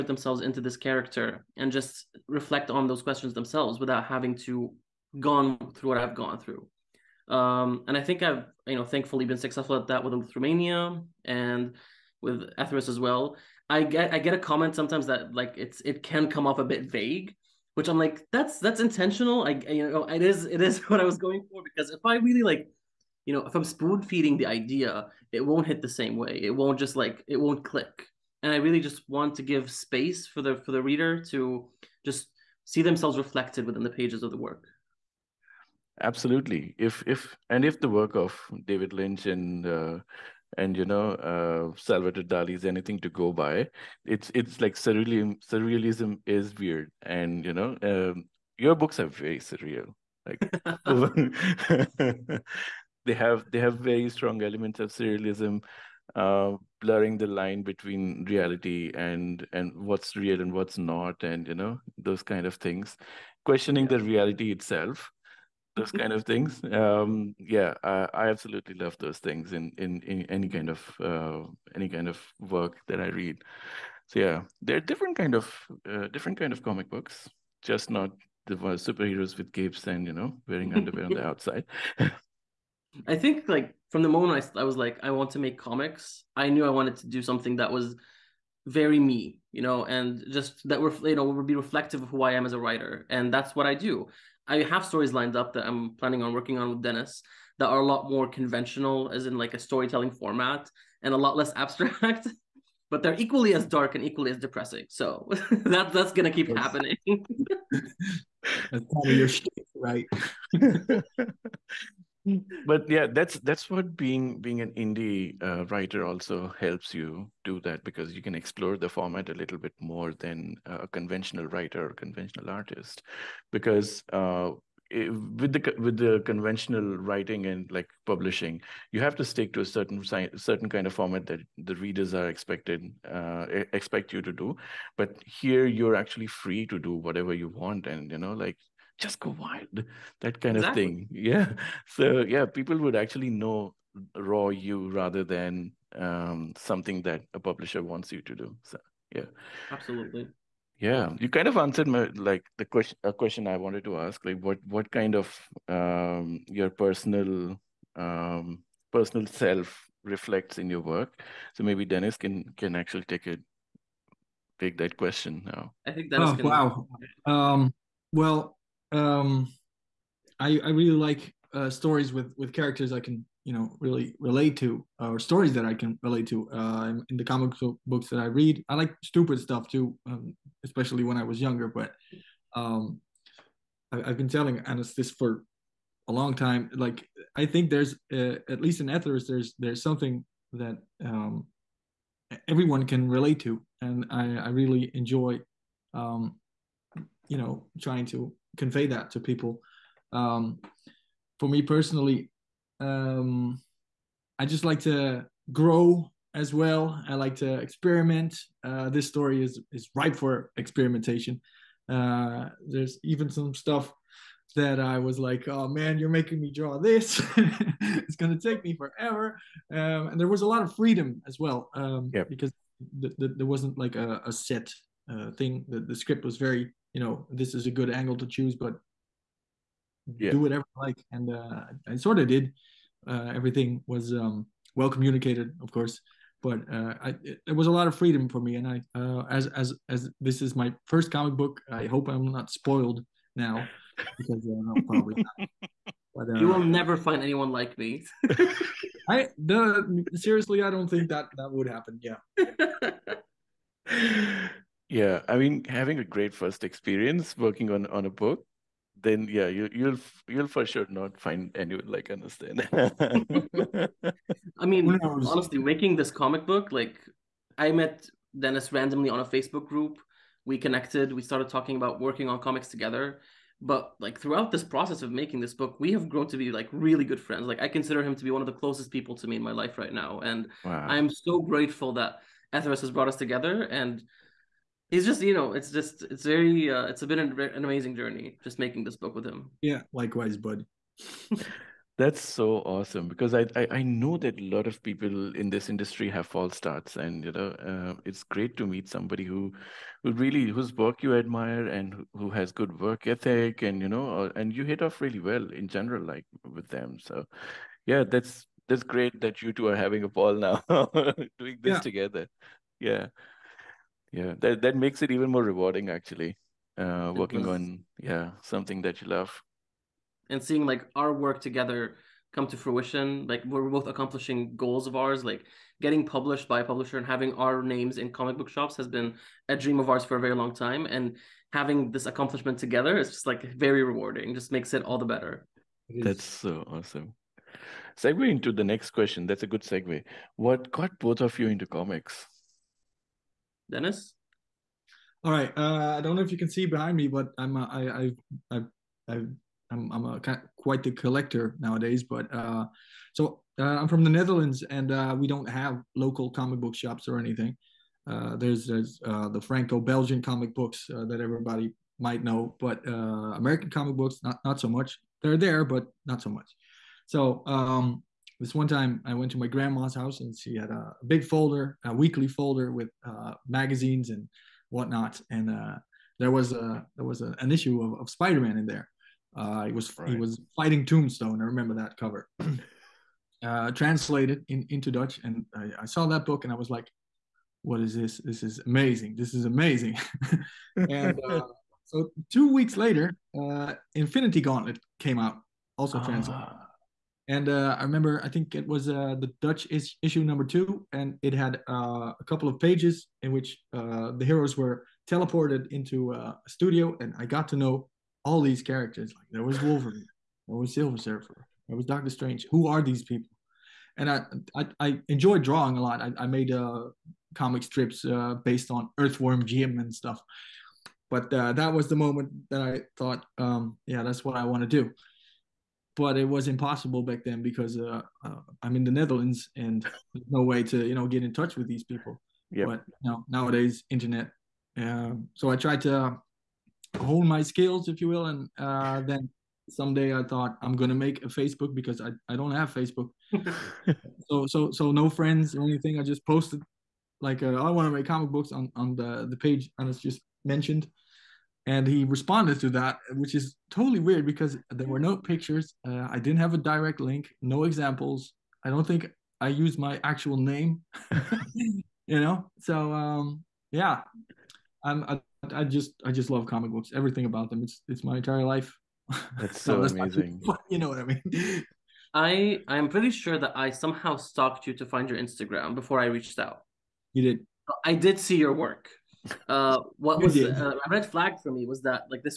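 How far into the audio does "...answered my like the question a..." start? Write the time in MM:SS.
02:31.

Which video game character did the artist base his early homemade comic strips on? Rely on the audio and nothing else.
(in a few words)
Earthworm Jim.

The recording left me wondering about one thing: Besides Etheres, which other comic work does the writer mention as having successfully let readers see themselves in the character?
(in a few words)
Eleutheromania.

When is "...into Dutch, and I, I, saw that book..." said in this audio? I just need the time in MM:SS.
06:24.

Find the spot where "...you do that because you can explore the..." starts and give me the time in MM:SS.
01:56.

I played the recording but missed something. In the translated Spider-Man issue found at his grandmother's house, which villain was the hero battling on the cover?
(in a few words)
Tombstone.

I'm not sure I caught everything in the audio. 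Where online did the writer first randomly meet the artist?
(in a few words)
Facebook group.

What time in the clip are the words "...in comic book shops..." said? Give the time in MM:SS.
05:27.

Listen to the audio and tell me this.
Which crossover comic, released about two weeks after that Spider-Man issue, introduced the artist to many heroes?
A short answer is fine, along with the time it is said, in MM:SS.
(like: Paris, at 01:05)
Infinity Gauntlet, at 06:33.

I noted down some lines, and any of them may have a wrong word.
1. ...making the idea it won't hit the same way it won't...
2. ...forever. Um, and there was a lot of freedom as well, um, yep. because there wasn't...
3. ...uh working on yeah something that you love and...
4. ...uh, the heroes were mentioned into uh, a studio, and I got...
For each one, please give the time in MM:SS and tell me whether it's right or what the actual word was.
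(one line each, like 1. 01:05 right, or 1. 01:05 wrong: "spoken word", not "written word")
1. 00:24 wrong: "feeding", not "making"
2. 03:38 right
3. 05:16 right
4. 06:43 wrong: "teleported", not "mentioned".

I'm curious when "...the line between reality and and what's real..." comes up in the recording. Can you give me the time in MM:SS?
00:57.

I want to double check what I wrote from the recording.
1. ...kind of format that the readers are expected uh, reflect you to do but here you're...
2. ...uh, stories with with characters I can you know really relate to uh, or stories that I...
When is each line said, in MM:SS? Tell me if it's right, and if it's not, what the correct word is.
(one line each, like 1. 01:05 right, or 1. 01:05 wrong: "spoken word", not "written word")
1. 02:10 wrong: "expect", not "reflect"
2. 02:51 right.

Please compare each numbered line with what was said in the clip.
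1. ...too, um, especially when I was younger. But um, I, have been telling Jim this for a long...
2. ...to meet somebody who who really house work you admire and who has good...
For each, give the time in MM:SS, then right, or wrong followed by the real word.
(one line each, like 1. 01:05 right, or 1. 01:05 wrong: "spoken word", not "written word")
1. 02:59 wrong: "Anas", not "Jim"
2. 04:58 wrong: "whose", not "house".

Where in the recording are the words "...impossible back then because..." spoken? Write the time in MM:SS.
07:06.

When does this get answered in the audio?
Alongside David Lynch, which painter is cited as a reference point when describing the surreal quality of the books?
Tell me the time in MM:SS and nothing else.
00:41.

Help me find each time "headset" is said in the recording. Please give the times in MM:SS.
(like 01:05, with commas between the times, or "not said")
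not said.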